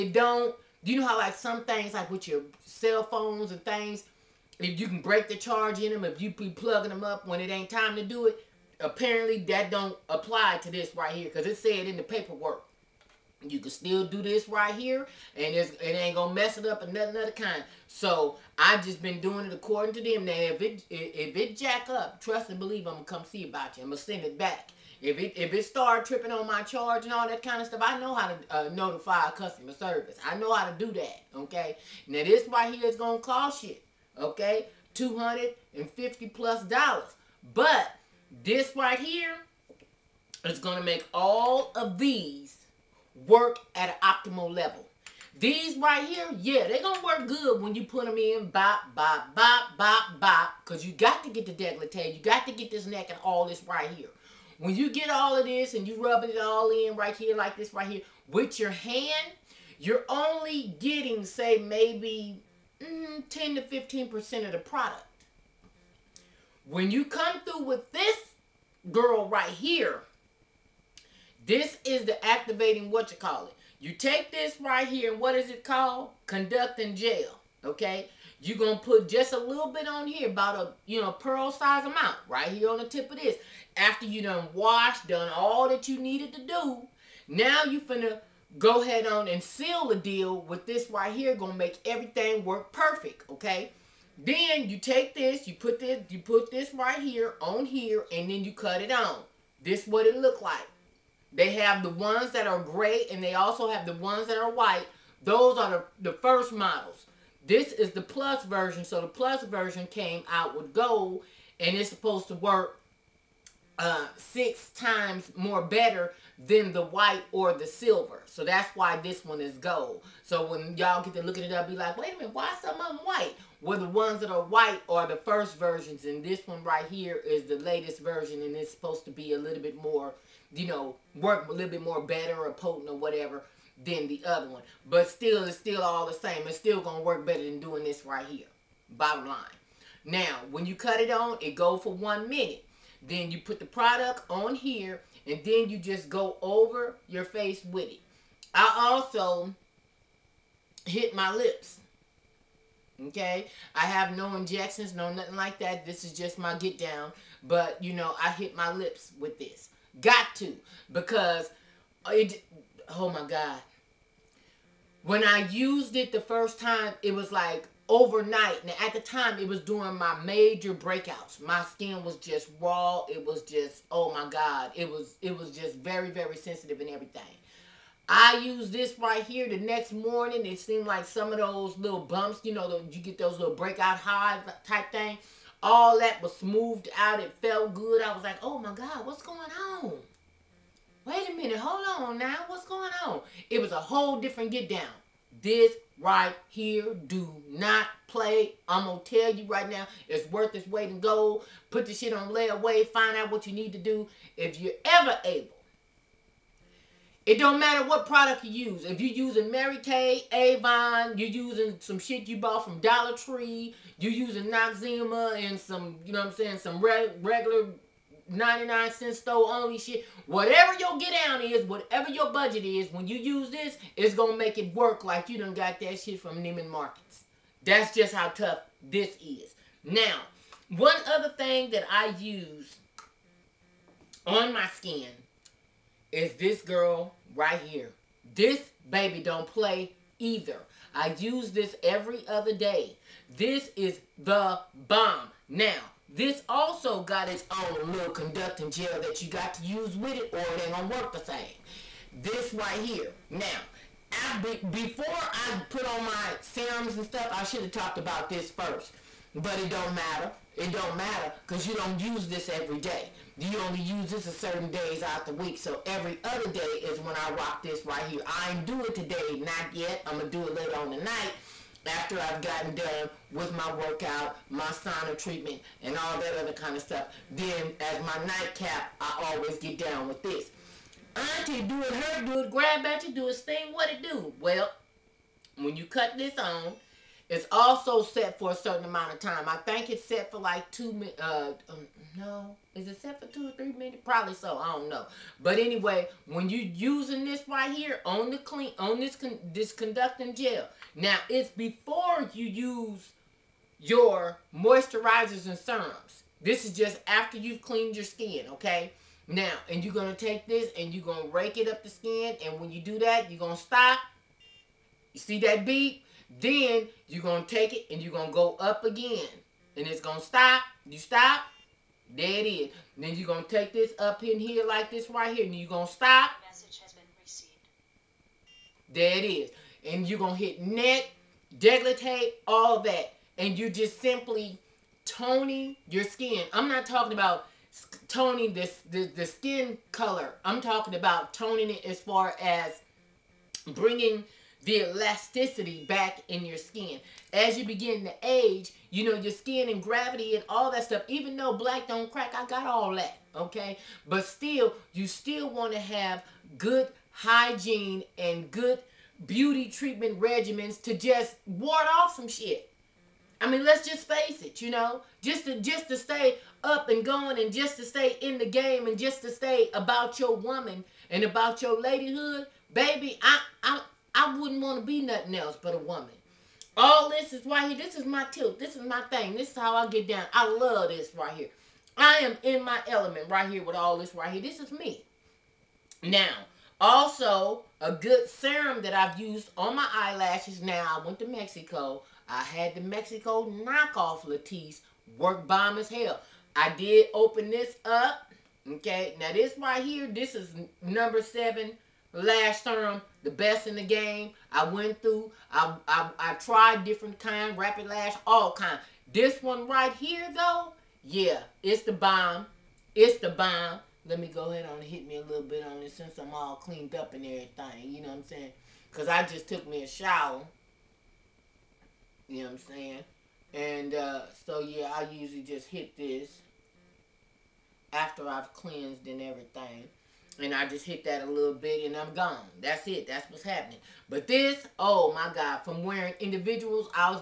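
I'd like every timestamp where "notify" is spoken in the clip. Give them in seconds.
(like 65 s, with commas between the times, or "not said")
28 s.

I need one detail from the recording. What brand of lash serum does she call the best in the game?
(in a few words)
Number 7.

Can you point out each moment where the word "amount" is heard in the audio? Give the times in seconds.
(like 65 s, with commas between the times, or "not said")
81 s, 288 s.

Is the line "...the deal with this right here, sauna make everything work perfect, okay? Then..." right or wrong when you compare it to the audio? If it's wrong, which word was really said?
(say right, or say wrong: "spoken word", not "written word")
wrong: "gonna", not "sauna".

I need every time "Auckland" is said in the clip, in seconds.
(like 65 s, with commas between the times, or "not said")
not said.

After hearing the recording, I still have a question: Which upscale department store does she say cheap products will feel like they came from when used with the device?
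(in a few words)
Neiman Marcus.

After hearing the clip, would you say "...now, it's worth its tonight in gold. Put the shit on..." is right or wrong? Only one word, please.
wrong.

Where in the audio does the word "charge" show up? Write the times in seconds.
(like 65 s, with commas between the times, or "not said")
5 s, 26 s.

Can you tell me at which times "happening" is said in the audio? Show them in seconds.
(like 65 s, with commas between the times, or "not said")
433 s.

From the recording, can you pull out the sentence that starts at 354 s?
But still, you still want to have good hygiene and good beauty treatment regimens to just ward off some shit.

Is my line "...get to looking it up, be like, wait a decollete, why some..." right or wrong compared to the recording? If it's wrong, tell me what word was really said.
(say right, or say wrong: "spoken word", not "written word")
wrong: "minute", not "decollete".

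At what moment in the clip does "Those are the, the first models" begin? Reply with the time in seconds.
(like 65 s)
105 s.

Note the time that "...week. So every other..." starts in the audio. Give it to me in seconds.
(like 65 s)
265 s.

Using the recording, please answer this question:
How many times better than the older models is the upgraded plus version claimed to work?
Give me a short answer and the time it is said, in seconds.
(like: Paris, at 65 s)
6, at 114 s.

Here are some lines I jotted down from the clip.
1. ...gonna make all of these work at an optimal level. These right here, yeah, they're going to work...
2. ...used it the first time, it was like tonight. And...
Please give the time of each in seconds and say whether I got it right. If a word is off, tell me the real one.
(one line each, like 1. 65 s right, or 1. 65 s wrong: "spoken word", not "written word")
1. 40 s right
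2. 165 s wrong: "overnight", not "tonight".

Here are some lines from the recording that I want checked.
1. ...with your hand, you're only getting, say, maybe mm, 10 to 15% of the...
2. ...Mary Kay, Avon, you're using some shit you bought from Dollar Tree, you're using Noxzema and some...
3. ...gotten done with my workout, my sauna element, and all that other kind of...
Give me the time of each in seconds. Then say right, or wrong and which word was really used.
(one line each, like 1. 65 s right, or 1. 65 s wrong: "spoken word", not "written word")
1. 58 s right
2. 209 s right
3. 272 s wrong: "treatment", not "element".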